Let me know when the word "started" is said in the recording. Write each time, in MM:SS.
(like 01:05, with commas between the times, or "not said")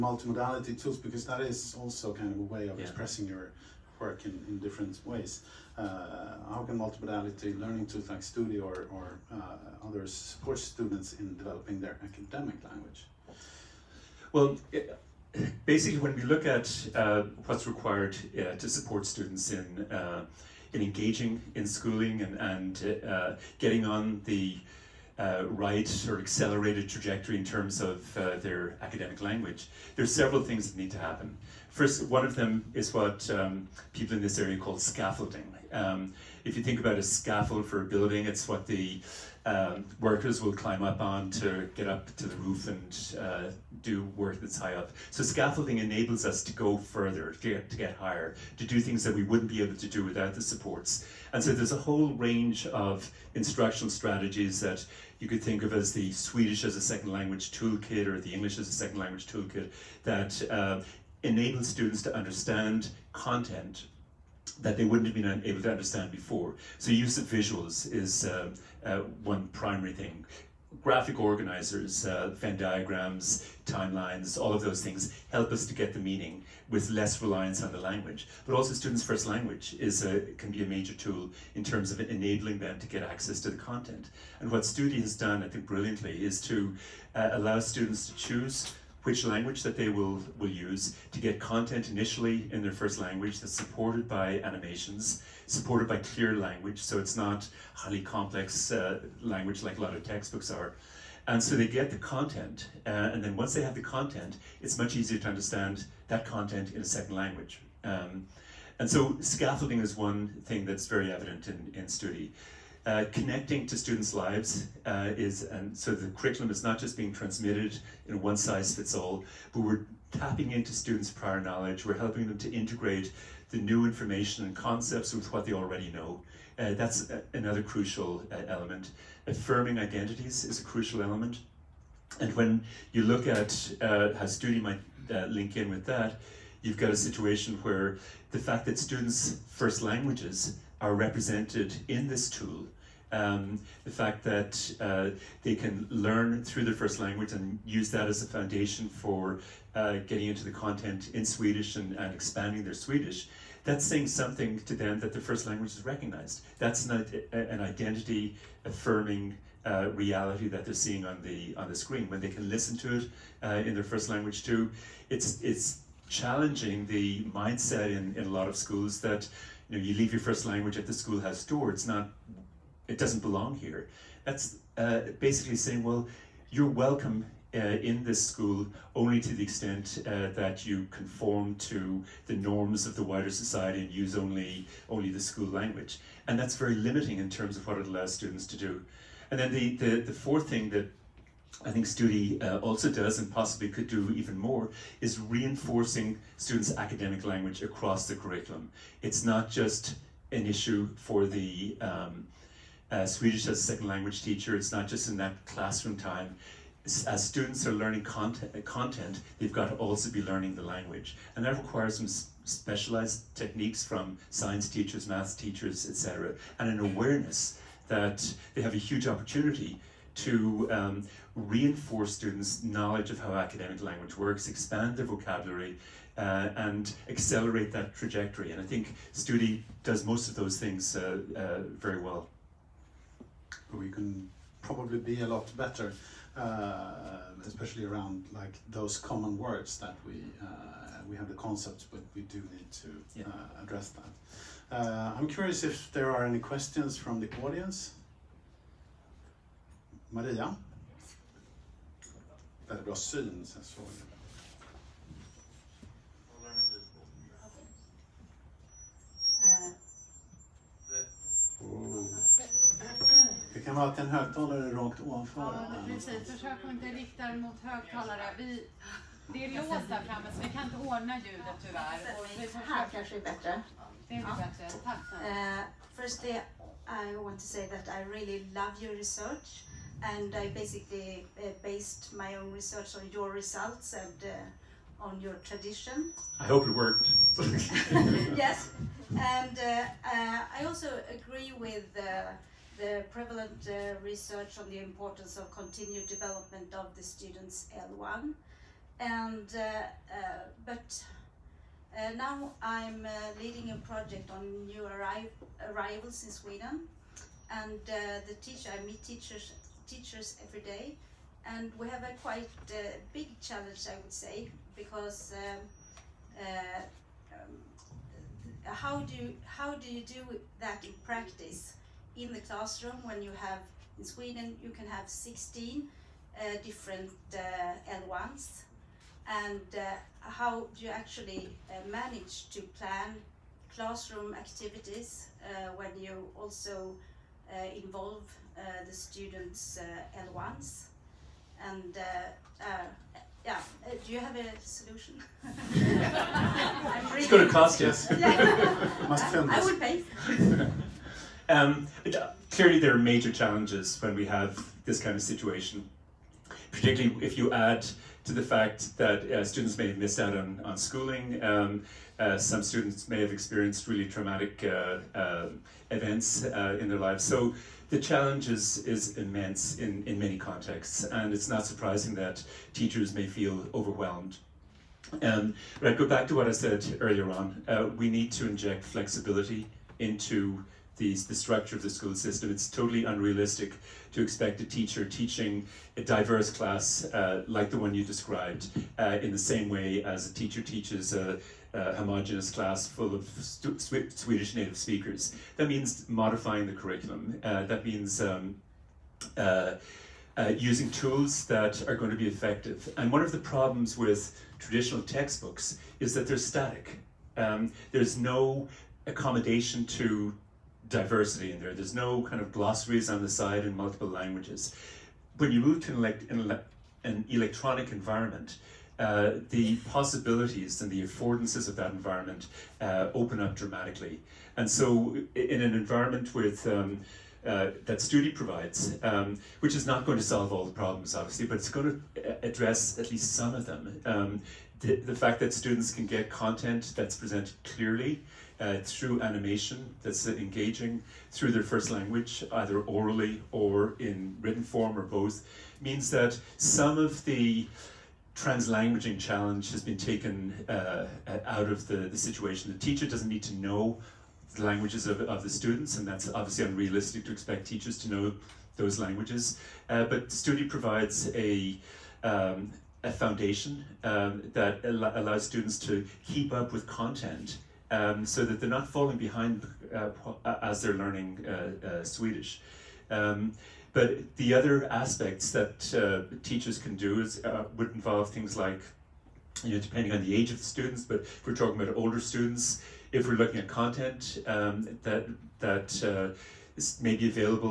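not said.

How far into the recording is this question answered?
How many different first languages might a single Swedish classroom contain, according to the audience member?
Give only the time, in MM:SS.
05:25.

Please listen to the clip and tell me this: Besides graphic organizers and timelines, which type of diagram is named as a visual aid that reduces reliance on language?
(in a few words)
Venn diagrams.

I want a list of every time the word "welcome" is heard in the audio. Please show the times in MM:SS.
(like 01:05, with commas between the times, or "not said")
02:56.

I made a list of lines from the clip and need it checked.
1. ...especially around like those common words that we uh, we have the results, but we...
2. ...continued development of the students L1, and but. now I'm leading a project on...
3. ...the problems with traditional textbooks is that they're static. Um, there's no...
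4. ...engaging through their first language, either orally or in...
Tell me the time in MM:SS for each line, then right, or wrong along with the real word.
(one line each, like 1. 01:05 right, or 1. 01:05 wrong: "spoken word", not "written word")
1. 03:57 wrong: "concepts", not "results"
2. 04:55 right
3. 06:43 right
4. 07:20 right.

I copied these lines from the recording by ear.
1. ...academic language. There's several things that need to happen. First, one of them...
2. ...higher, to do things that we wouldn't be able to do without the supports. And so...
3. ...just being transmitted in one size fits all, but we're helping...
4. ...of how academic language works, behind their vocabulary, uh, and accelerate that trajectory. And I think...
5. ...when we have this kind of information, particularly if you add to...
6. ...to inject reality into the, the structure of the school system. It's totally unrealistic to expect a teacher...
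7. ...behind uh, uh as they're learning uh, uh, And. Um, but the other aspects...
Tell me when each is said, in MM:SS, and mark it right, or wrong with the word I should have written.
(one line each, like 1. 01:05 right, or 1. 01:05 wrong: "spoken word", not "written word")
1. 00:28 right
2. 00:47 right
3. 01:56 wrong: "tapping", not "helping"
4. 03:43 wrong: "expand", not "behind"
5. 05:54 wrong: "situation", not "information"
6. 06:18 wrong: "flexibility", not "reality"
7. 07:49 wrong: "Swedish", not "And".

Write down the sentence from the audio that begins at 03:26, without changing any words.
as students are learning content, content, they've got to also be learning the language.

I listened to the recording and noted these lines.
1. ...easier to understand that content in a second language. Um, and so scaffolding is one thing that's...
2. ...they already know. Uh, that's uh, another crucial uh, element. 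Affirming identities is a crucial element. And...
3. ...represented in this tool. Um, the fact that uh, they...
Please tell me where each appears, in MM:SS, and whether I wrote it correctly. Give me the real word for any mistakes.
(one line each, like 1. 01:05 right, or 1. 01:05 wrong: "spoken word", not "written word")
1. 01:44 right
2. 02:05 right
3. 02:20 right.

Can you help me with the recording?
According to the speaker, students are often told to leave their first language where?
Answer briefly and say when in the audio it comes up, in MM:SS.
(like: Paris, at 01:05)
At the schoolhouse door, at 02:50.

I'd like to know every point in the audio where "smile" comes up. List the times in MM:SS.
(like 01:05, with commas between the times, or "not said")
not said.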